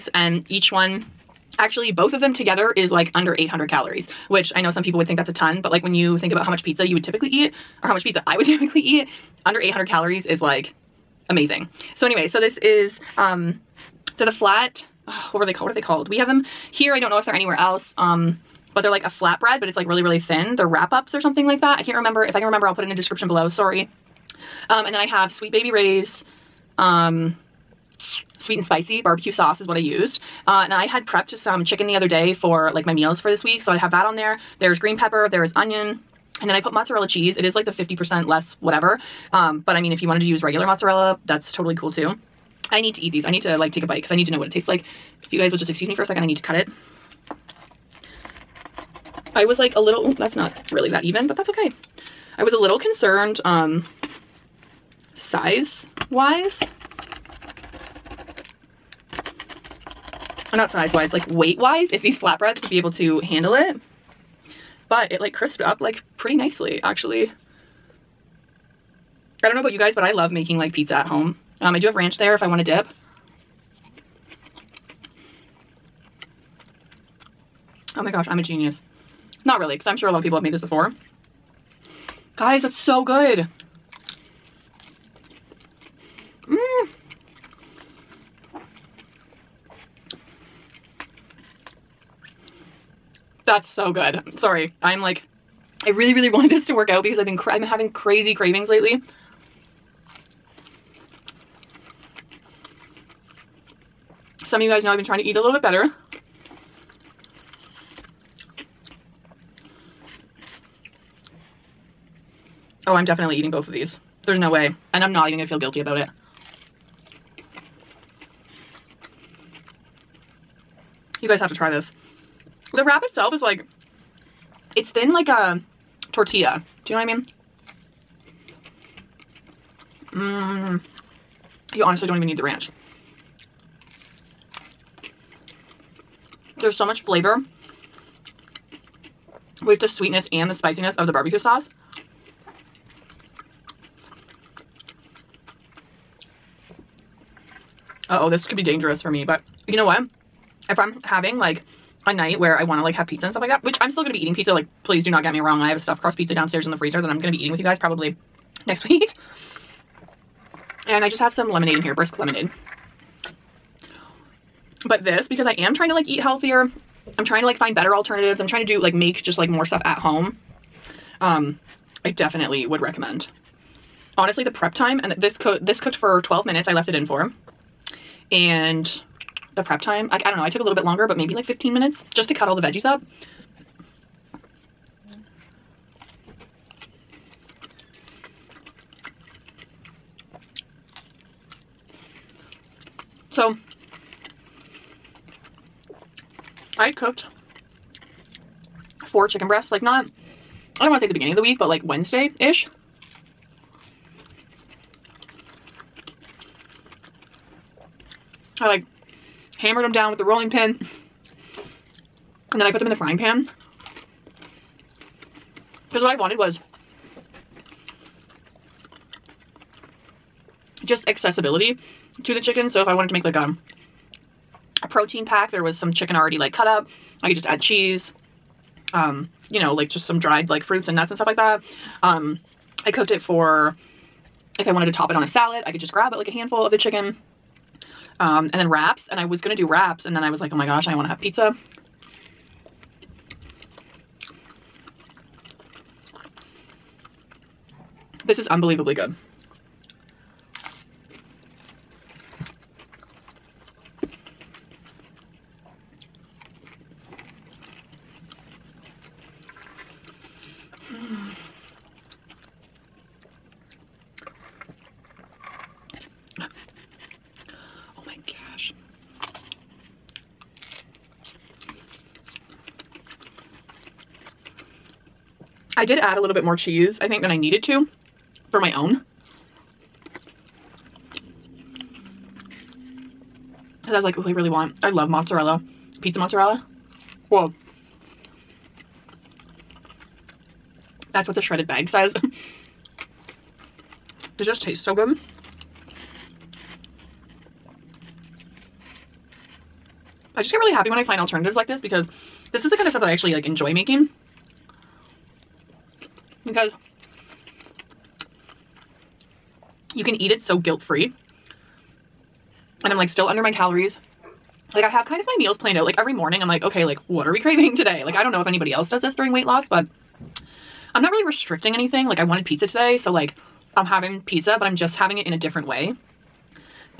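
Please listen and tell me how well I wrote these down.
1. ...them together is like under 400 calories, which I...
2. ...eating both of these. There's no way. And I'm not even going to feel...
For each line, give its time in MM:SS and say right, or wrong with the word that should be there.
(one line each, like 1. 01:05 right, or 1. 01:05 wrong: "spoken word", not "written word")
1. 00:02 wrong: "800", not "400"
2. 01:53 right.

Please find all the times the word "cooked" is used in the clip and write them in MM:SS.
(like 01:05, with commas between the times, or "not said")
02:55, 03:16, 03:52.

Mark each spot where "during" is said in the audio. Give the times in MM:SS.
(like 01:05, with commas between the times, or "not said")
05:19.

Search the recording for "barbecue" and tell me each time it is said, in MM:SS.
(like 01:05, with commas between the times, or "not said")
00:28, 02:21.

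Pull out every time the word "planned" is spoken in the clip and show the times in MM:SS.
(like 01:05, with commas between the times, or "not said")
05:15.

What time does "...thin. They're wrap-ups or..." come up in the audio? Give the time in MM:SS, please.
00:20.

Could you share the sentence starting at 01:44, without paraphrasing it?
Some of you guys know I've been trying to eat a little bit better.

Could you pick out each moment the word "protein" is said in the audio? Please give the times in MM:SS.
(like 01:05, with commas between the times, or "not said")
03:44.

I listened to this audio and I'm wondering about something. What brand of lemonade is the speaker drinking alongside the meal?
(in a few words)
Brisk.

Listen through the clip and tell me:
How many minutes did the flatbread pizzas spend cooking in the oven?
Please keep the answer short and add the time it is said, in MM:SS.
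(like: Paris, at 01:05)
12, at 02:56.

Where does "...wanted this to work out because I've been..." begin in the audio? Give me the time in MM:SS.
01:36.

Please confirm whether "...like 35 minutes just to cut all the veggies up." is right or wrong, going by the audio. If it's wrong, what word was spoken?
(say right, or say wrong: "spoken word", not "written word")
wrong: "15", not "35".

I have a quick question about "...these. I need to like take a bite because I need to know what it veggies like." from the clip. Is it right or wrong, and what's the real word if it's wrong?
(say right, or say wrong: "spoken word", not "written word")
wrong: "tastes", not "veggies".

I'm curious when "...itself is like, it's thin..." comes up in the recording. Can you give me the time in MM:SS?
02:03.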